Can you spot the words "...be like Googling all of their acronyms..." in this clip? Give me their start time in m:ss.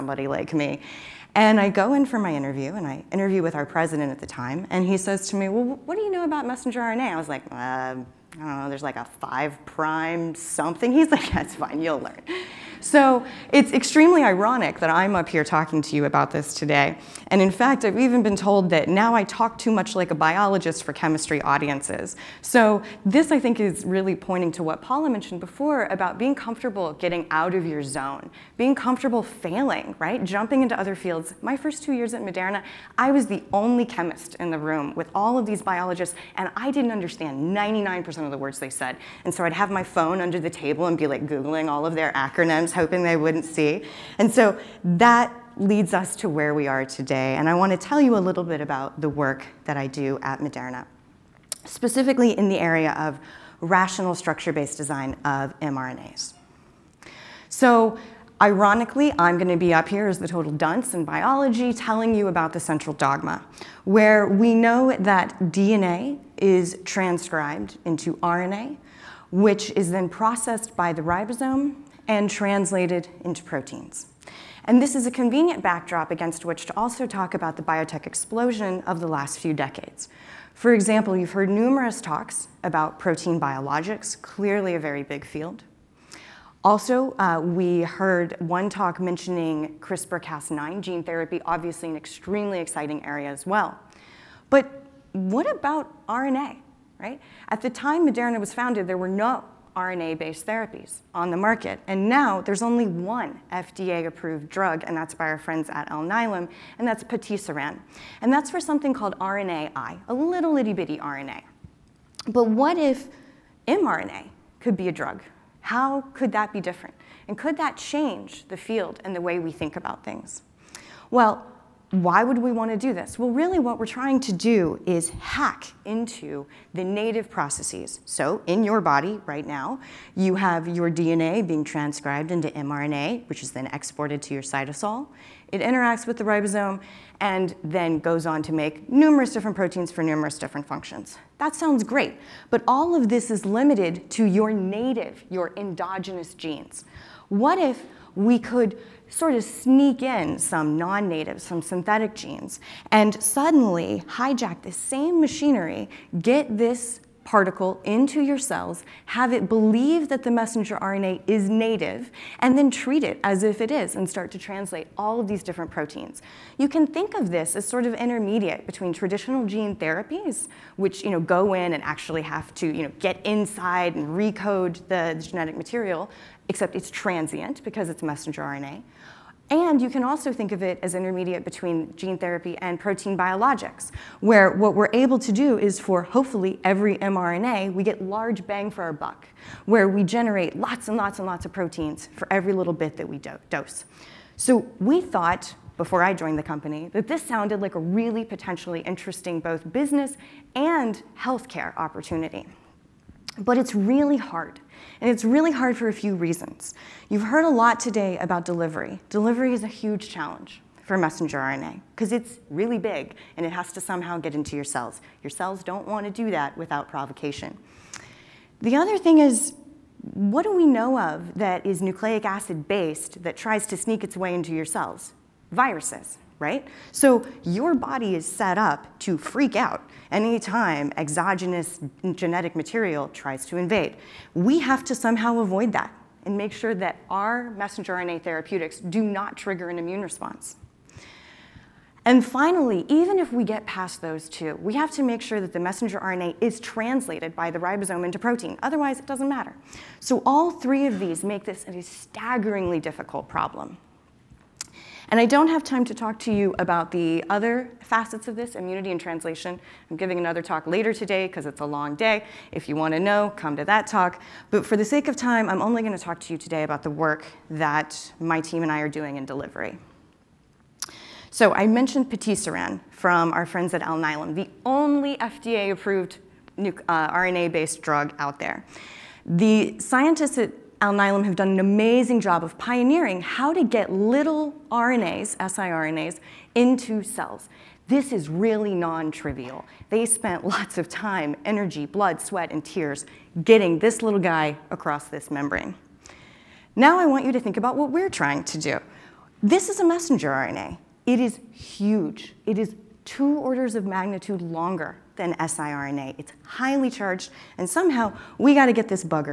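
0:40.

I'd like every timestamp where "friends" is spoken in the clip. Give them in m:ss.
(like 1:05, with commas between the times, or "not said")
1:45, 4:33.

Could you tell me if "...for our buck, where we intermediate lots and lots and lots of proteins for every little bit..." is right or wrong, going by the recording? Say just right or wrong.
wrong.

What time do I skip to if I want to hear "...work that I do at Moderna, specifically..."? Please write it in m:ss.
0:49.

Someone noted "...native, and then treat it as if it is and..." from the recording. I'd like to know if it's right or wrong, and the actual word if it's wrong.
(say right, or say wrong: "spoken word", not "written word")
right.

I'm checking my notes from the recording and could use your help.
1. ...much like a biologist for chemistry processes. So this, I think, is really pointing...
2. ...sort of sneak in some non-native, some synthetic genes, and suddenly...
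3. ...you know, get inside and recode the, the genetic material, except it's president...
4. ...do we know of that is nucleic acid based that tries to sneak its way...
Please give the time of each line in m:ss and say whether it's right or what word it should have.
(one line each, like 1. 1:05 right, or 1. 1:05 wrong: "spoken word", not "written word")
1. 0:19 wrong: "audiences", not "processes"
2. 2:29 right
3. 2:52 wrong: "transient", not "president"
4. 3:40 right.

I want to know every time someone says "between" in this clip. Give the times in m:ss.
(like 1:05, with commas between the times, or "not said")
2:48, 3:01.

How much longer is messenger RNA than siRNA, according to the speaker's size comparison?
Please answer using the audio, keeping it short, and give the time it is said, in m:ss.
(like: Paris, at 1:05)
2 orders of magnitude, at 5:03.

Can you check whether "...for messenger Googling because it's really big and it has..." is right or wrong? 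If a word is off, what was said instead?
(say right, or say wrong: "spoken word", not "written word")
wrong: "RNA", not "Googling".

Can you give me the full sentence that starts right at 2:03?
Well, really what we're trying to do is hack into the native processes.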